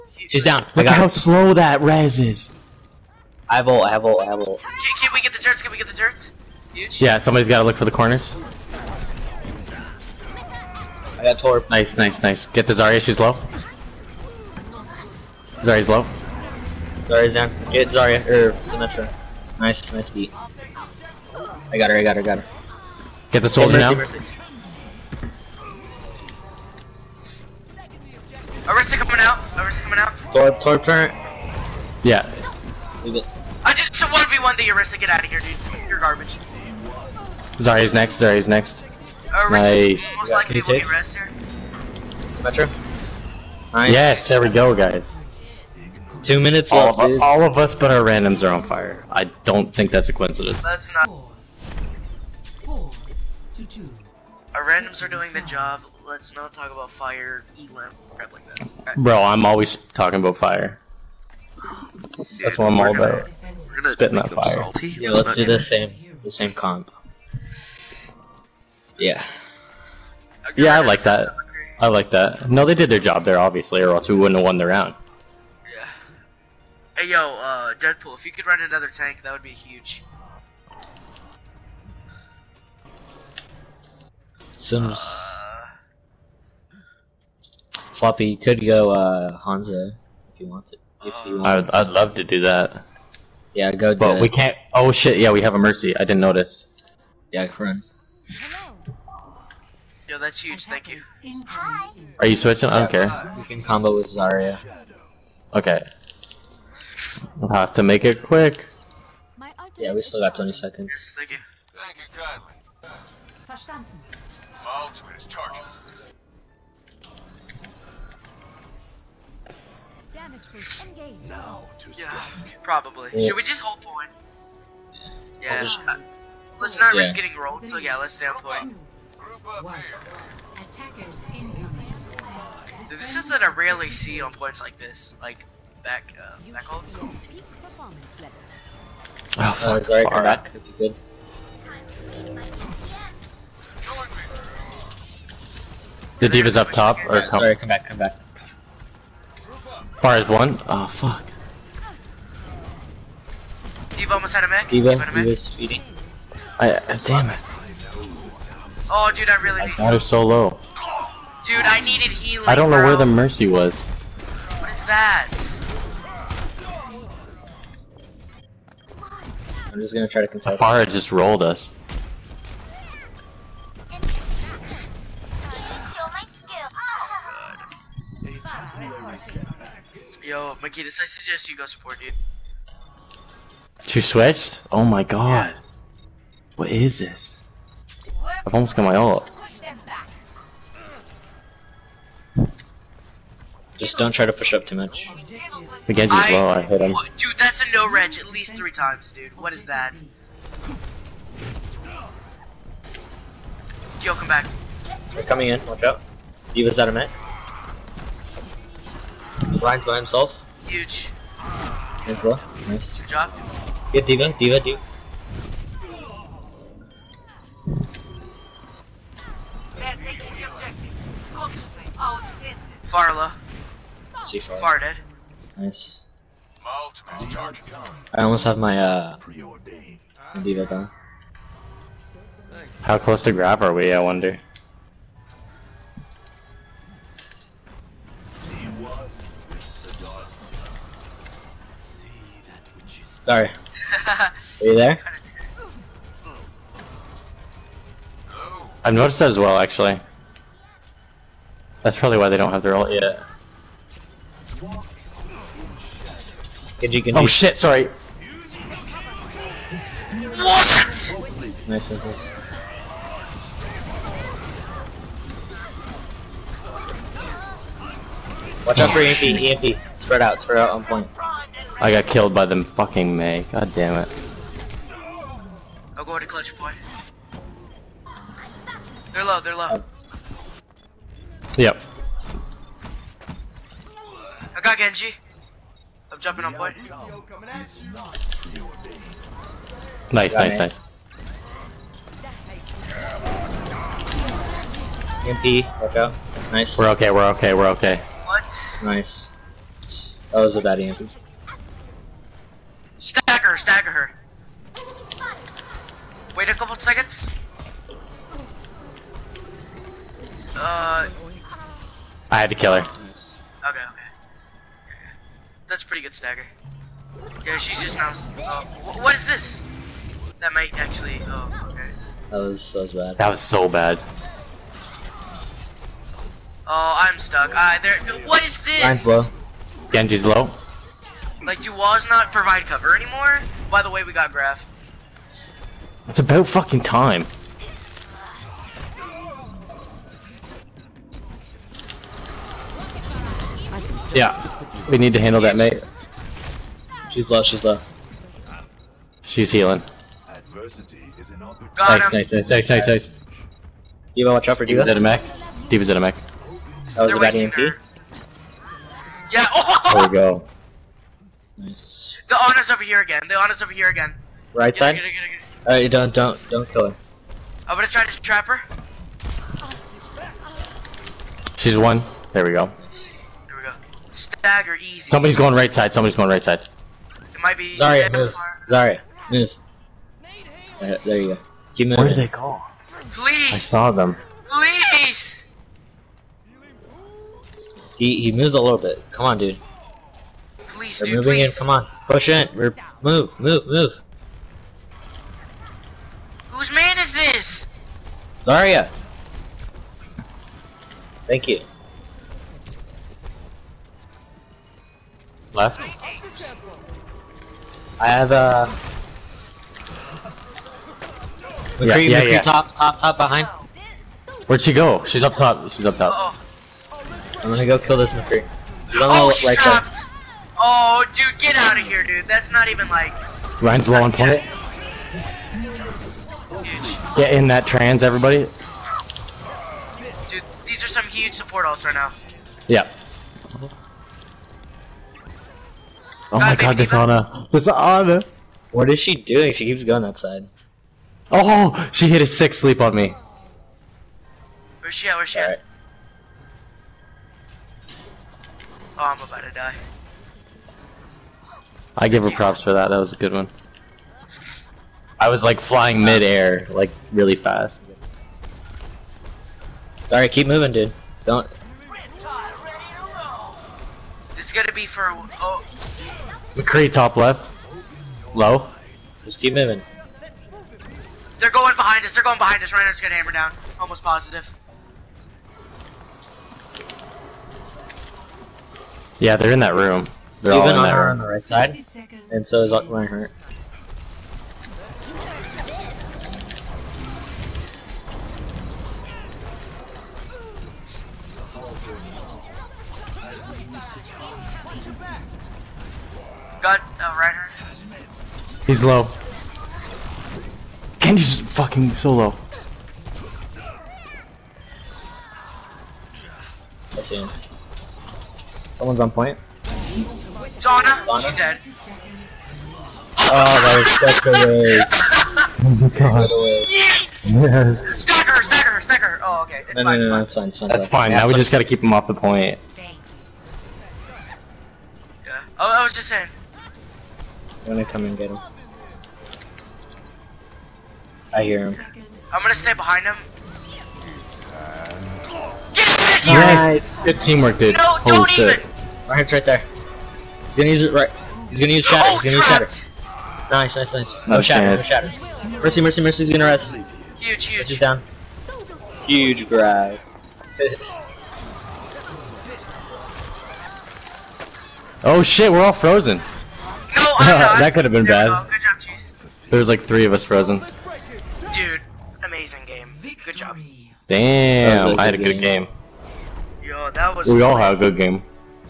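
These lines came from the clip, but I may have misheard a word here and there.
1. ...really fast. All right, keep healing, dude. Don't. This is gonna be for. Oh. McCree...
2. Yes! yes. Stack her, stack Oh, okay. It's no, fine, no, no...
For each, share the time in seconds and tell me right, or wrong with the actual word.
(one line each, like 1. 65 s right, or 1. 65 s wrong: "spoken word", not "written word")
1. 457 s wrong: "moving", not "healing"
2. 516 s right.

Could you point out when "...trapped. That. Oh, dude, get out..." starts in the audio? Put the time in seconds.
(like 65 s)
419 s.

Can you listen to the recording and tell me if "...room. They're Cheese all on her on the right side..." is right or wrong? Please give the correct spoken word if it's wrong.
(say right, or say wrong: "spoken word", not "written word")
wrong: "Even", not "Cheese".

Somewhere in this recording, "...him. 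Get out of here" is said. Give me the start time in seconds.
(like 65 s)
533 s.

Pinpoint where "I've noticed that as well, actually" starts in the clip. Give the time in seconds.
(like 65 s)
248 s.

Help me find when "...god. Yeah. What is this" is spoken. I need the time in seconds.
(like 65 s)
185 s.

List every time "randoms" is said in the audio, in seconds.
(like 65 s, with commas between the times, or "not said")
48 s, 54 s.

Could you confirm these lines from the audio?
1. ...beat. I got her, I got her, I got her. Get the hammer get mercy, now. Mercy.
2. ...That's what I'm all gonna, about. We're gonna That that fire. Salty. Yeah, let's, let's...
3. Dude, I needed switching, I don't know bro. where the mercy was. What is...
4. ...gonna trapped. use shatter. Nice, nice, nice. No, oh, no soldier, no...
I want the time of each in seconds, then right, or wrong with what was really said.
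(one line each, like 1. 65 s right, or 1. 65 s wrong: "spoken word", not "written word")
1. 20 s wrong: "soldier", not "hammer"
2. 62 s wrong: "Spitting", not "That"
3. 161 s wrong: "healing", not "switching"
4. 542 s wrong: "shatter", not "soldier".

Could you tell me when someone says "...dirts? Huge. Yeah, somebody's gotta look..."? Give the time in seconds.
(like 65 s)
5 s.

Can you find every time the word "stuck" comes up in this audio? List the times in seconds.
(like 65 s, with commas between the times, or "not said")
327 s.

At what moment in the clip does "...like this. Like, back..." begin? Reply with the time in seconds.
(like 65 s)
134 s.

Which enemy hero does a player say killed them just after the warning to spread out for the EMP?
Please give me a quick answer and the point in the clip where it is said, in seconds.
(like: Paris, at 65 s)
Mei, at 273 s.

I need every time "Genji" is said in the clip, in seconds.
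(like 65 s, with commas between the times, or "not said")
195 s, 284 s, 329 s, 500 s.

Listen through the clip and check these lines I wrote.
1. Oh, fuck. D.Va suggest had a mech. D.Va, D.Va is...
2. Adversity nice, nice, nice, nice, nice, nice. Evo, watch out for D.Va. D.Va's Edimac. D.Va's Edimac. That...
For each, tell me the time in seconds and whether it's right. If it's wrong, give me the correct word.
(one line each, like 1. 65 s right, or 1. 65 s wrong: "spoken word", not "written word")
1. 150 s wrong: "almost", not "suggest"
2. 350 s right.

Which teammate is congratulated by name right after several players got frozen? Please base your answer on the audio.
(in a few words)
Cheese.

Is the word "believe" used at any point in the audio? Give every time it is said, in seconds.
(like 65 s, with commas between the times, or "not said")
not said.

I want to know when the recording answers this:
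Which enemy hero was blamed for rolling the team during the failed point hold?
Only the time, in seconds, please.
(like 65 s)
170 s.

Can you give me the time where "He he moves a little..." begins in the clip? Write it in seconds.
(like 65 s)
387 s.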